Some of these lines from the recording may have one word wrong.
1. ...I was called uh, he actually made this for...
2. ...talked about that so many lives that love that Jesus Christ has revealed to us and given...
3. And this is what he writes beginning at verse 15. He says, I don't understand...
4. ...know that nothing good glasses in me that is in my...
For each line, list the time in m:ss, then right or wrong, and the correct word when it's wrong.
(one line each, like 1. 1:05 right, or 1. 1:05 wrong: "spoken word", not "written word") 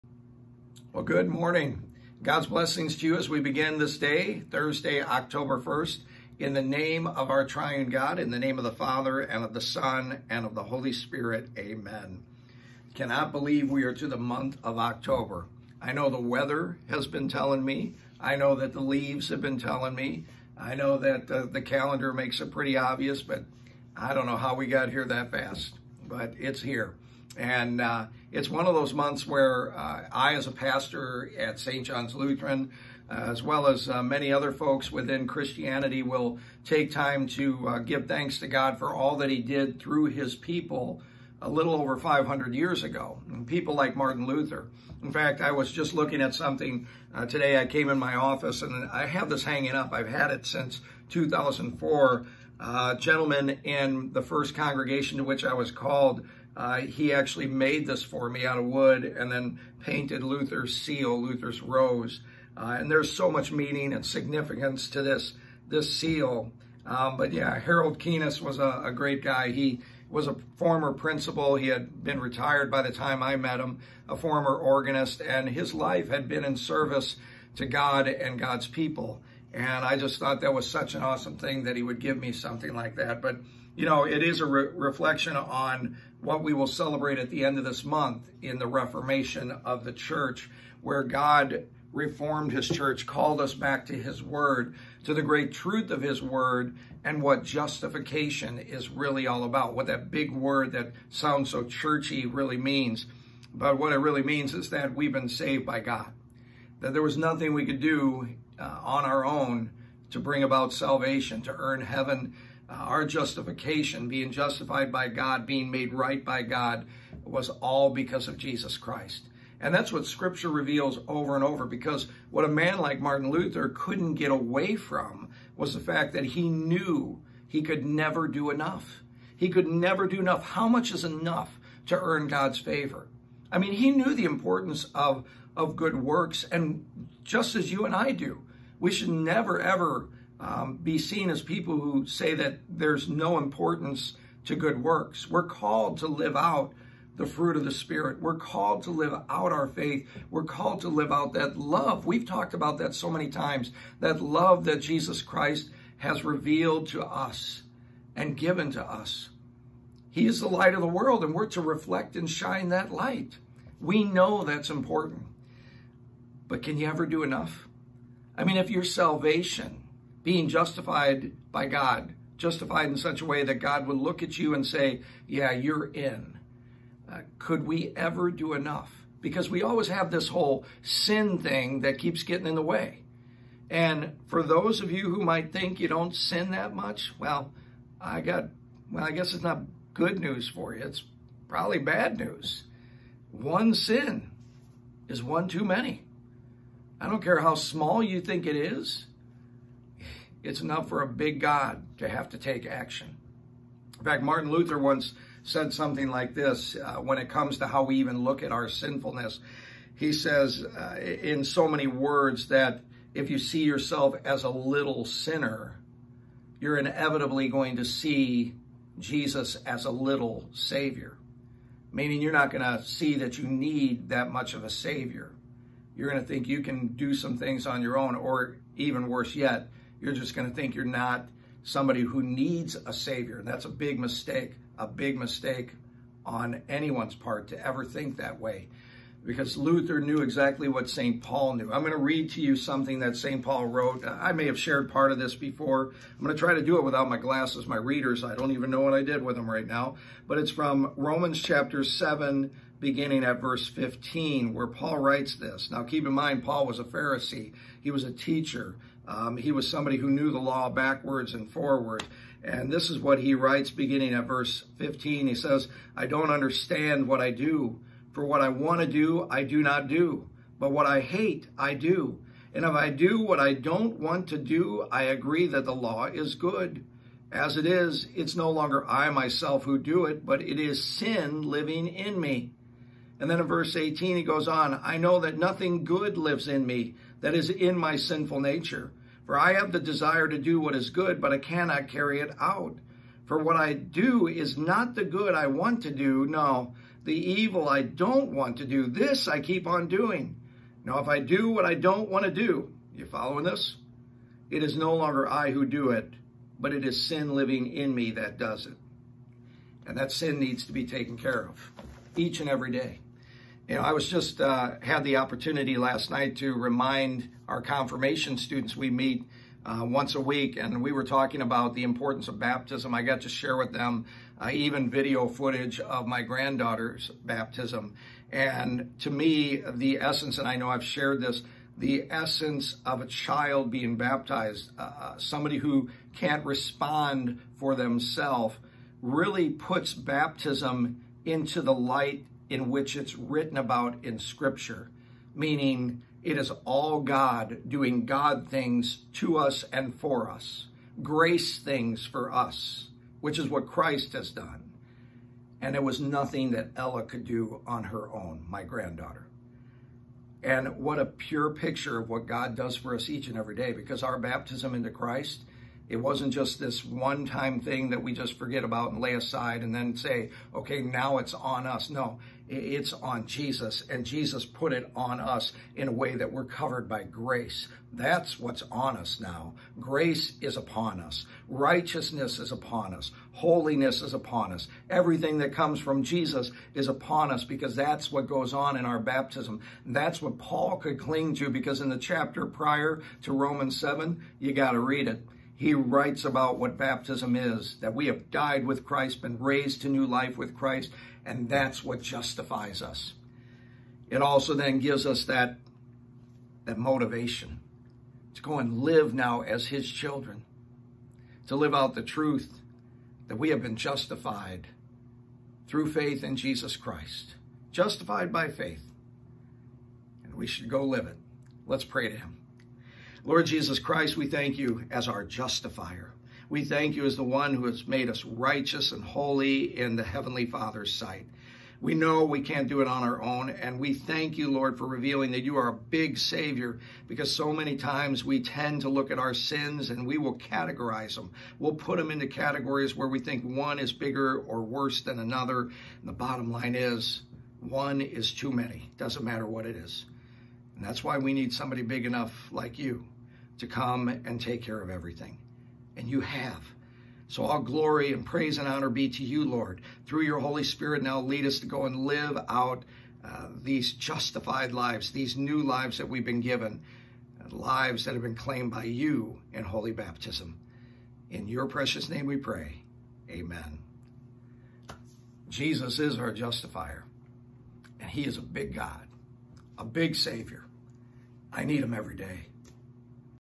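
1. 0:55 right
2. 2:32 wrong: "times", not "lives"
3. 4:22 right
4. 4:44 wrong: "lives", not "glasses".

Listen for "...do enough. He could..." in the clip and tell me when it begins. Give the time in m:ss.
2:08.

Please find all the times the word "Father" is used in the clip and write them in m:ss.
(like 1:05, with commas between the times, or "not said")
0:08, 7:10.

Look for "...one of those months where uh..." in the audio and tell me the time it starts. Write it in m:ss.
0:28.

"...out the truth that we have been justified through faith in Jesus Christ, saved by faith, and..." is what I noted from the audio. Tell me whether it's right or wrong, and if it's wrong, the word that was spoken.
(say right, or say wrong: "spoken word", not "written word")
wrong: "justified", not "saved".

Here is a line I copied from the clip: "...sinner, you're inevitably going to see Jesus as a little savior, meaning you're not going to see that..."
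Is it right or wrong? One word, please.
right.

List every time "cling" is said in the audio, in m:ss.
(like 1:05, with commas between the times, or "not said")
6:30.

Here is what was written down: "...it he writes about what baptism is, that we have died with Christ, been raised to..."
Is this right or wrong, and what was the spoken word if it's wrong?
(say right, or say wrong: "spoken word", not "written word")
right.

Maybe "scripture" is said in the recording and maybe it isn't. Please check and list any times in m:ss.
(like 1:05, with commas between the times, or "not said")
2:00, 5:44.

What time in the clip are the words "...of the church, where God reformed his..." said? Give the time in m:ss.
1:29.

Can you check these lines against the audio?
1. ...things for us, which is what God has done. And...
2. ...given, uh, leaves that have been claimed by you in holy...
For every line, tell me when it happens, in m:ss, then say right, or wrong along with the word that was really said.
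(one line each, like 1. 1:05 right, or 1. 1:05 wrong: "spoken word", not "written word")
1. 5:51 wrong: "Christ", not "God"
2. 7:46 wrong: "lives", not "leaves".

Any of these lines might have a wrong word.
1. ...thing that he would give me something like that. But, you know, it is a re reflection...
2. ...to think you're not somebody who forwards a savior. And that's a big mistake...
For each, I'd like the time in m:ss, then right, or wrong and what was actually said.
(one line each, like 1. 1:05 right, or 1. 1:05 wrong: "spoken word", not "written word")
1. 1:21 right
2. 3:50 wrong: "needs", not "forwards".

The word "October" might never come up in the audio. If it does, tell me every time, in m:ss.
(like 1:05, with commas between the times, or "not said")
0:05, 0:14.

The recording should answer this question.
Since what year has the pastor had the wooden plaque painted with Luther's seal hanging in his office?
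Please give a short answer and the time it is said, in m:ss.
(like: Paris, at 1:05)
2004, at 0:51.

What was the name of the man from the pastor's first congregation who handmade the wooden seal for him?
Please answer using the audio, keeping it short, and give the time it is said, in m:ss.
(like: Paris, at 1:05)
Harold Keenis, at 1:07.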